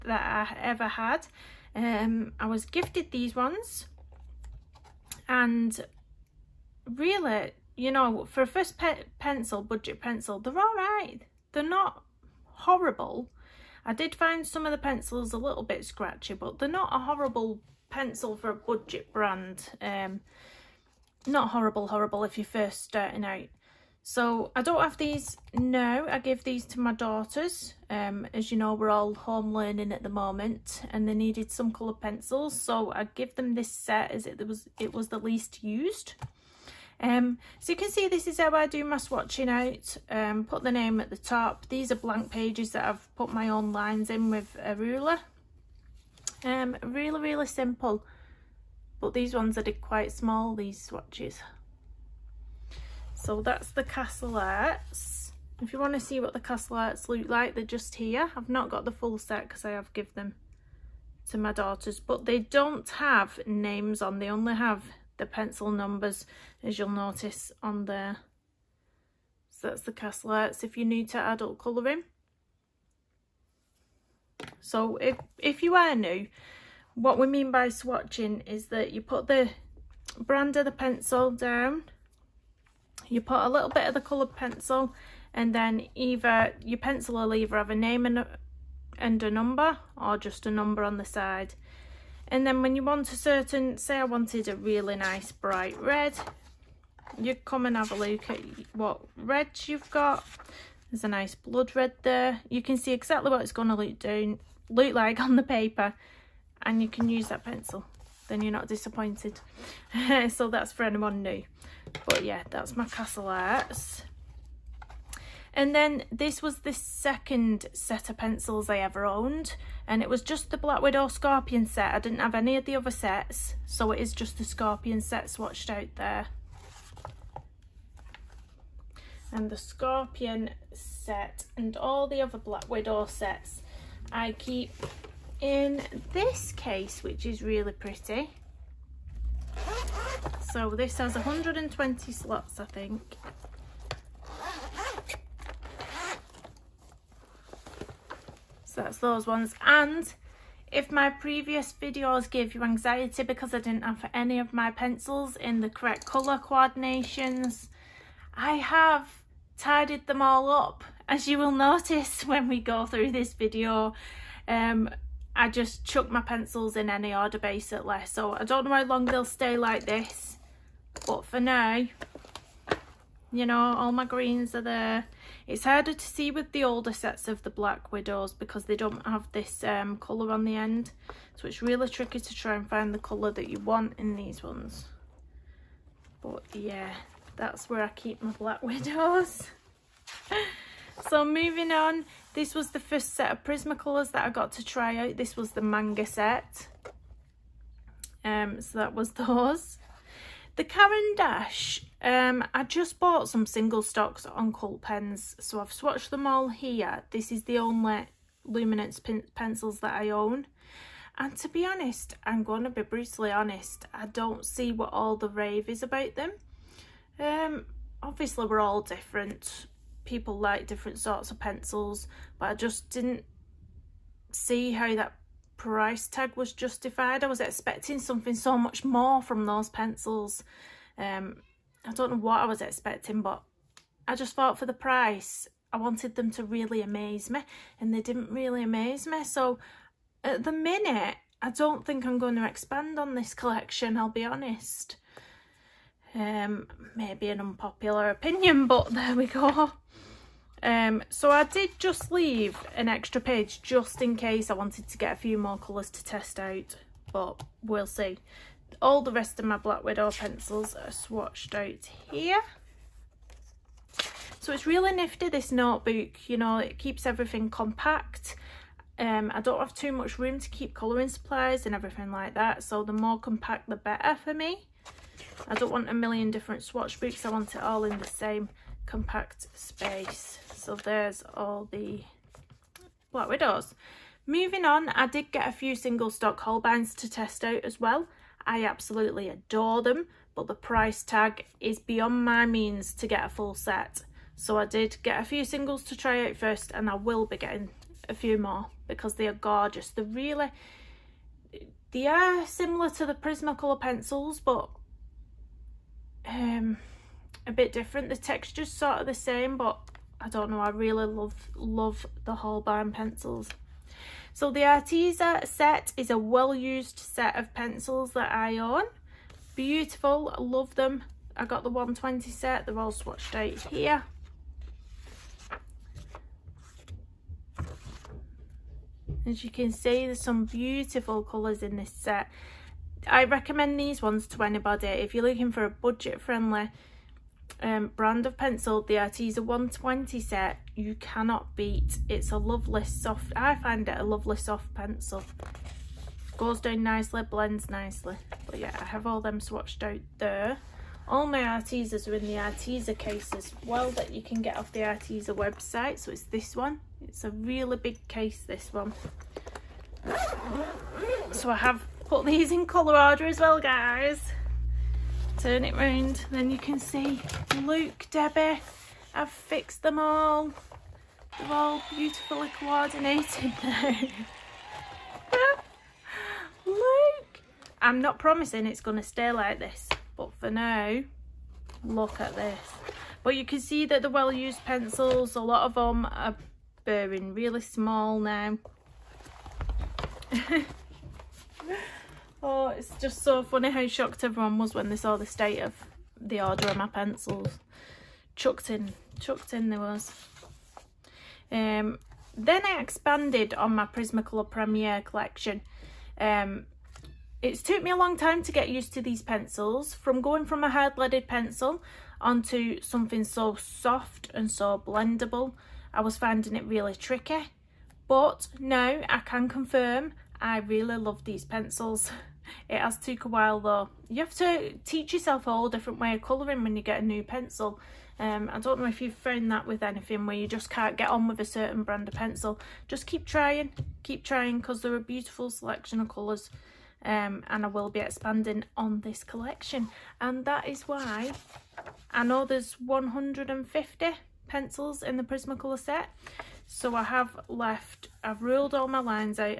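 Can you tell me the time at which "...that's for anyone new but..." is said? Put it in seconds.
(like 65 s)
110 s.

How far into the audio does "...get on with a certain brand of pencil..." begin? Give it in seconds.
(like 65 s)
430 s.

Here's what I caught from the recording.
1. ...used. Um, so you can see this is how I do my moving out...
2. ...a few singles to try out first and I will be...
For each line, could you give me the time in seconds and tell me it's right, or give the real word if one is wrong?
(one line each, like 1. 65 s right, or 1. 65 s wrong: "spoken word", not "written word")
1. 35 s wrong: "swatching", not "moving"
2. 295 s right.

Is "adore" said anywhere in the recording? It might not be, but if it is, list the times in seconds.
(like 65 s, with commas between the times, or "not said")
289 s.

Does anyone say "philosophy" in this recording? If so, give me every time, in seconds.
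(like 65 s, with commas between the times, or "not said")
not said.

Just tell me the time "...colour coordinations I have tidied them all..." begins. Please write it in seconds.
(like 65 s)
156 s.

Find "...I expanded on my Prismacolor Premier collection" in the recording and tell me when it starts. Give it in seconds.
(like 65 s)
402 s.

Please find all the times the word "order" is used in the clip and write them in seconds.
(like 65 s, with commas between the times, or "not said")
167 s, 396 s.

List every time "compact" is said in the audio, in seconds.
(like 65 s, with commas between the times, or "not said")
267 s, 273 s, 278 s.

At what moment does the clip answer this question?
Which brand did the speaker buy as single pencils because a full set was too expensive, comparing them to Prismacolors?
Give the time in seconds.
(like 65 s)
286 s.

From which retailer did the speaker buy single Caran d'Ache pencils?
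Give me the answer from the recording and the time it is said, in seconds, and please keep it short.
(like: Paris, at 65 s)
Cult Pens, at 204 s.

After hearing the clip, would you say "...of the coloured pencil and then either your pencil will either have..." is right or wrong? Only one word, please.
right.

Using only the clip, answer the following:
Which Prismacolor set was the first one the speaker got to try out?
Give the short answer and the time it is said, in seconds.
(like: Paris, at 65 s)
manga set, at 195 s.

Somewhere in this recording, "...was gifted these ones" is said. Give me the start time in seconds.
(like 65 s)
2 s.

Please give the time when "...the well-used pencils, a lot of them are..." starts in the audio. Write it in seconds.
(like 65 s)
384 s.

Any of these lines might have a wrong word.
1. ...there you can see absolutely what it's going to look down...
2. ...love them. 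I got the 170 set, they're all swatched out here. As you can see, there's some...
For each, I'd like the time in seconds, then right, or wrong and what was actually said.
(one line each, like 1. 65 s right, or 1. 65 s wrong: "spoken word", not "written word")
1. 102 s wrong: "exactly", not "absolutely"
2. 320 s wrong: "120", not "170".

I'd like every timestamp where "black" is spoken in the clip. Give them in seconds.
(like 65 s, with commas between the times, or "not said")
120 s, 132 s, 177 s, 188 s, 259 s, 283 s.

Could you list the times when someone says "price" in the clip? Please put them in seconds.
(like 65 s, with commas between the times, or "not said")
225 s, 234 s, 290 s.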